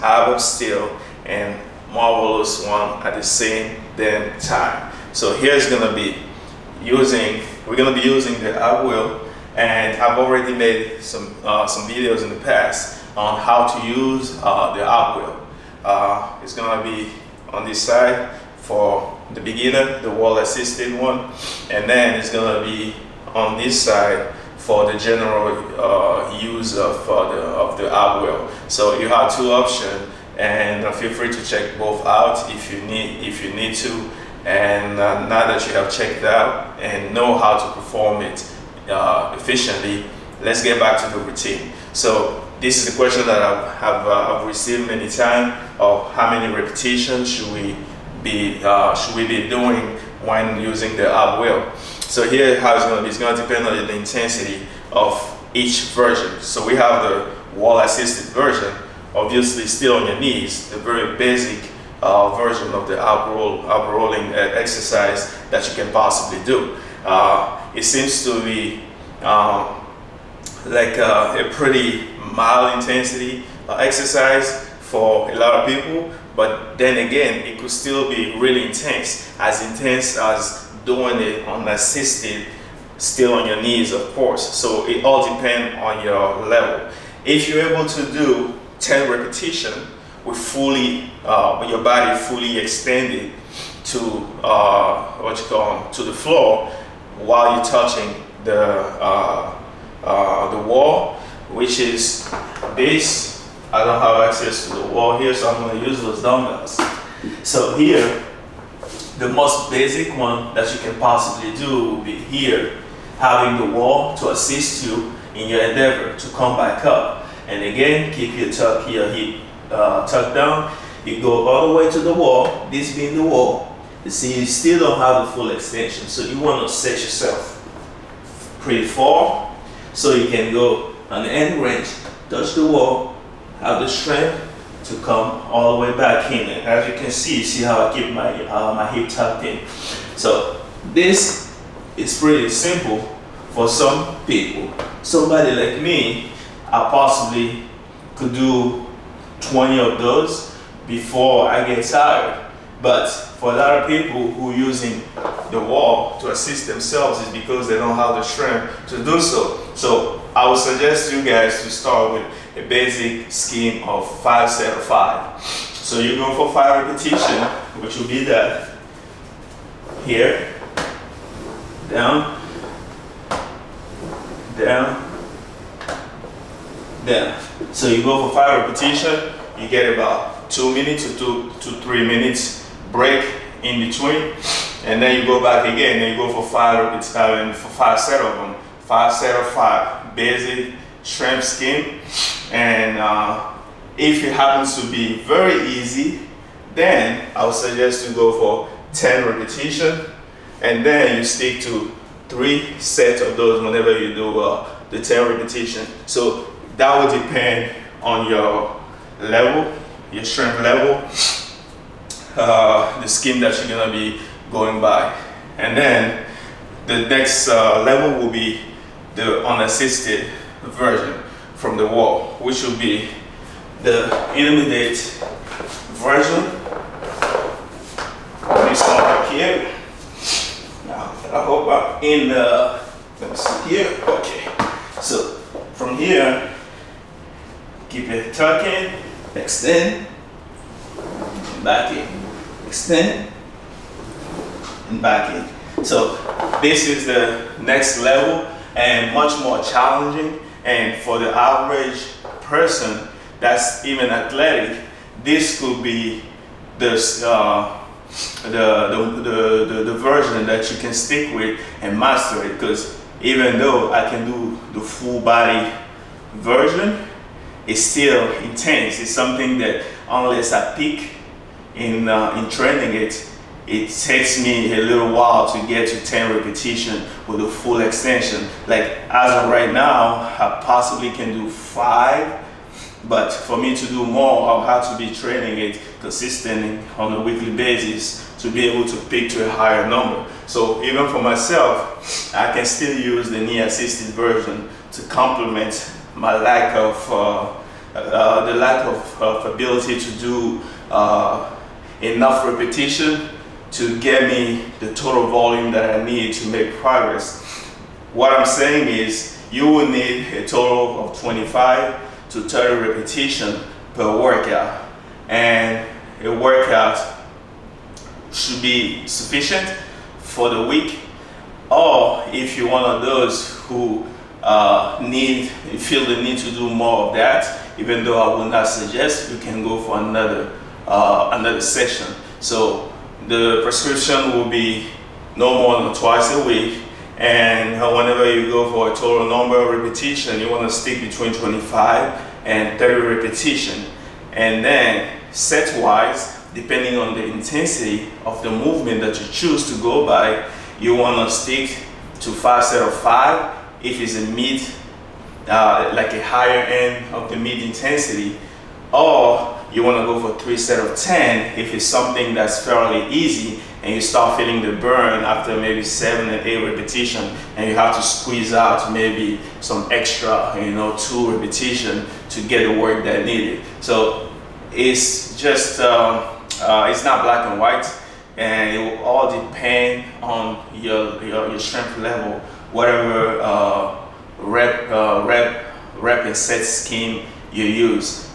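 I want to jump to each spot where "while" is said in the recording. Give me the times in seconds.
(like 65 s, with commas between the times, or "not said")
97 s, 275 s.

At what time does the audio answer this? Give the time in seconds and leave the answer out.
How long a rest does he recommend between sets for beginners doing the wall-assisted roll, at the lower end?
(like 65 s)
180 s.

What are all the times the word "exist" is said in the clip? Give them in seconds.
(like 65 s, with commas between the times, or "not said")
not said.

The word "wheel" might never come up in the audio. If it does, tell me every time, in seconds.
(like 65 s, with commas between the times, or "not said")
8 s, 15 s, 28 s, 51 s.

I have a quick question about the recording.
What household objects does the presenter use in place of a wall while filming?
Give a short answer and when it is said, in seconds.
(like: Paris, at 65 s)
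dumbbells, at 106 s.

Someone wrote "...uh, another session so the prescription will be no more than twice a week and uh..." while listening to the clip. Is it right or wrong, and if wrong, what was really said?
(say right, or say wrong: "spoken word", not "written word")
right.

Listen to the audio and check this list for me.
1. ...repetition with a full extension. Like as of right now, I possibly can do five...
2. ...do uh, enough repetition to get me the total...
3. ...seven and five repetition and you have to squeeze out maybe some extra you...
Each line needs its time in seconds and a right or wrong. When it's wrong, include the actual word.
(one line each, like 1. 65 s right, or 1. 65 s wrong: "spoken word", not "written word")
1. 276 s right
2. 300 s right
3. 365 s wrong: "eight", not "five".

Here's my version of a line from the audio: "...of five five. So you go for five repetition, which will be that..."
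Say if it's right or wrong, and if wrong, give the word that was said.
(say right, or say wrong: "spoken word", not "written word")
right.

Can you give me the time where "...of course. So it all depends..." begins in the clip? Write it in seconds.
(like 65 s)
83 s.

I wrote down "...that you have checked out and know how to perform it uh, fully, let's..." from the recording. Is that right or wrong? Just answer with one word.
wrong.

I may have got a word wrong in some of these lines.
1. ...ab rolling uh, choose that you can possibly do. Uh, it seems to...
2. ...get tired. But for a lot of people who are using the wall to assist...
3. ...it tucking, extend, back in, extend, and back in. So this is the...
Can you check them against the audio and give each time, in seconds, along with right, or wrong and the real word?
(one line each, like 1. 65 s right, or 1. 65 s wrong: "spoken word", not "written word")
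1. 63 s wrong: "exercise", not "choose"
2. 151 s right
3. 238 s right.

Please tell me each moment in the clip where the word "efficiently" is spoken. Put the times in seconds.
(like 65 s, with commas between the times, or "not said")
39 s.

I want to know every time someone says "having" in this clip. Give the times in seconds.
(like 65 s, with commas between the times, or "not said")
113 s.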